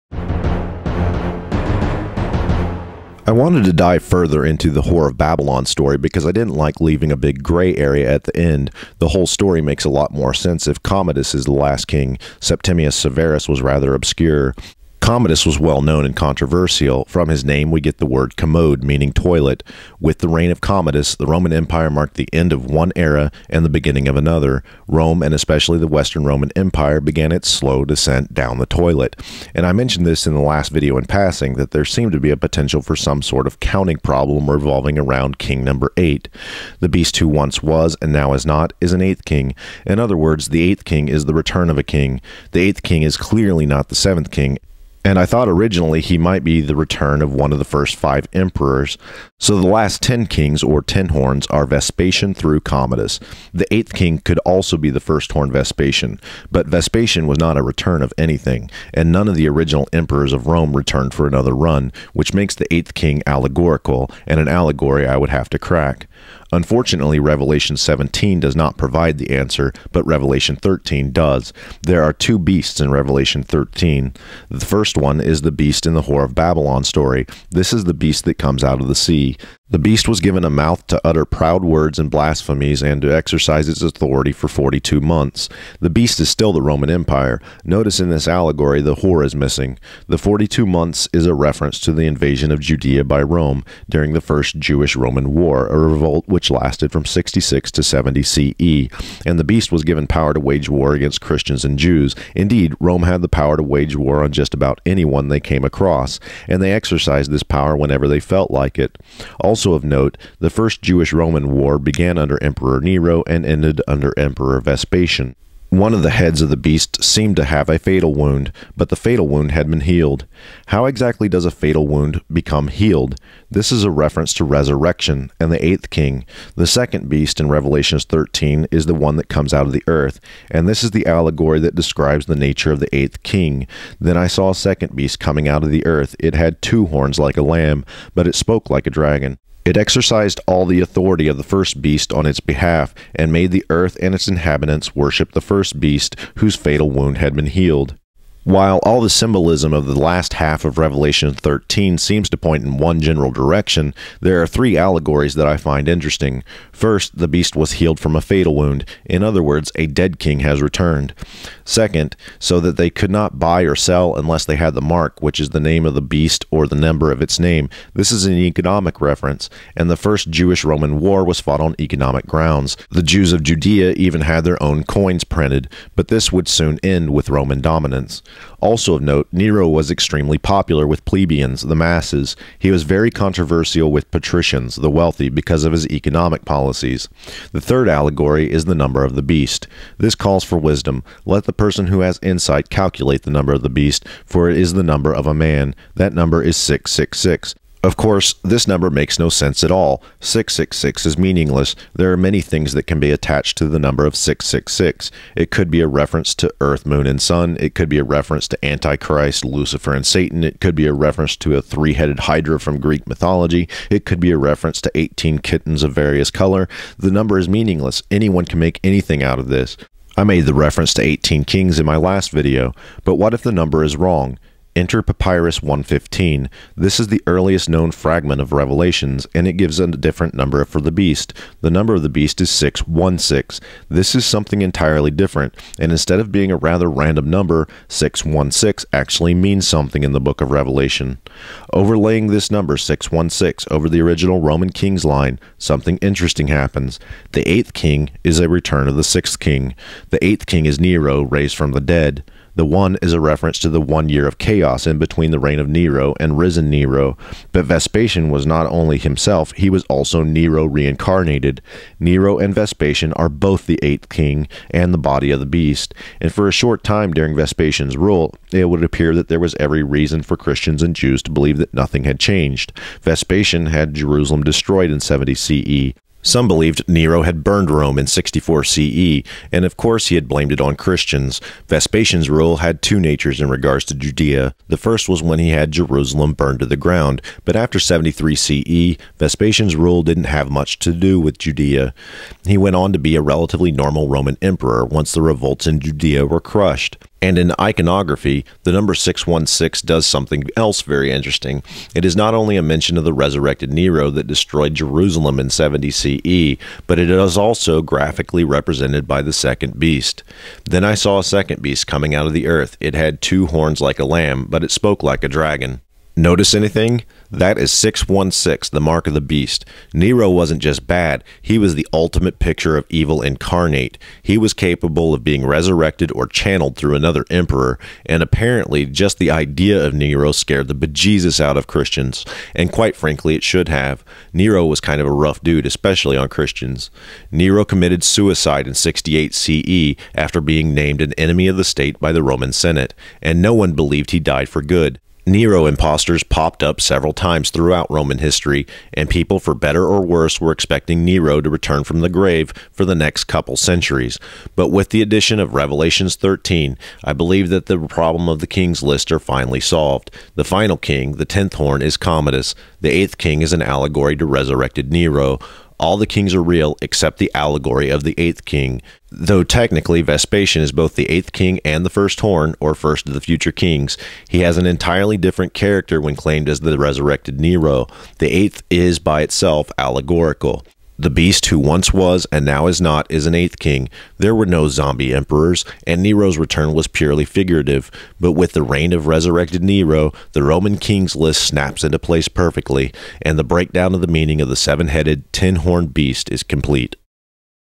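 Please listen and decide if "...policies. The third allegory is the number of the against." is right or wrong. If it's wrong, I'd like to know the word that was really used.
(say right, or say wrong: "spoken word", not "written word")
wrong: "beast", not "against".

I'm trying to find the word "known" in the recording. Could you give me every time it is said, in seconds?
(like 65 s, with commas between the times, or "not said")
15 s, 227 s.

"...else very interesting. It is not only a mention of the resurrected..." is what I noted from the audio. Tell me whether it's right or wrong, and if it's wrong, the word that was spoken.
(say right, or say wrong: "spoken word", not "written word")
right.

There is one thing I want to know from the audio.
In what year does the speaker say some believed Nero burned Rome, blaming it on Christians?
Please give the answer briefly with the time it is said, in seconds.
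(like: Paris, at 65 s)
64 CE, at 278 s.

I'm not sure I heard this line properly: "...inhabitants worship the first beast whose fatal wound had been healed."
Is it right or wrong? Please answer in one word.
right.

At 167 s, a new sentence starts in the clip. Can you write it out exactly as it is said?
This is an economic reference, and the first Jewish Roman war was fought on economic grounds.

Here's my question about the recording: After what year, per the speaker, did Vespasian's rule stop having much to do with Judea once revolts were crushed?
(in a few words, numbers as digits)
73 CE.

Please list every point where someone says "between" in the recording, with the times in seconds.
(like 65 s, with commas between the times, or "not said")
254 s.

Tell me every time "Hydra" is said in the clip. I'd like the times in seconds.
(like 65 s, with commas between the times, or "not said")
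212 s.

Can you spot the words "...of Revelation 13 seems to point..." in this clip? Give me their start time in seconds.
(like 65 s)
150 s.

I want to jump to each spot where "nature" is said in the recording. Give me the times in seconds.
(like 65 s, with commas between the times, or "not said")
132 s, 282 s.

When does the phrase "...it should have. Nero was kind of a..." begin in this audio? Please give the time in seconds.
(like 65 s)
333 s.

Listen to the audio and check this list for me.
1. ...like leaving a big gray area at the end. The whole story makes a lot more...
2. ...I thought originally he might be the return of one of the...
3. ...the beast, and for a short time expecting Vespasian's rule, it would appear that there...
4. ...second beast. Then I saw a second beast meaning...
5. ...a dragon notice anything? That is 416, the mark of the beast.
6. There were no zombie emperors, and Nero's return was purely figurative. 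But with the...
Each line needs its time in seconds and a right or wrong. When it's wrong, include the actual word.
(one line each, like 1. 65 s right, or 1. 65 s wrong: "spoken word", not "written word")
1. 6 s right
2. 45 s right
3. 265 s wrong: "during", not "expecting"
4. 309 s wrong: "coming", not "meaning"
5. 315 s wrong: "616", not "416"
6. 384 s right.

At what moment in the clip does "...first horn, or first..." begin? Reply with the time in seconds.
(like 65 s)
371 s.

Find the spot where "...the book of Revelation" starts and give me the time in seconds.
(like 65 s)
240 s.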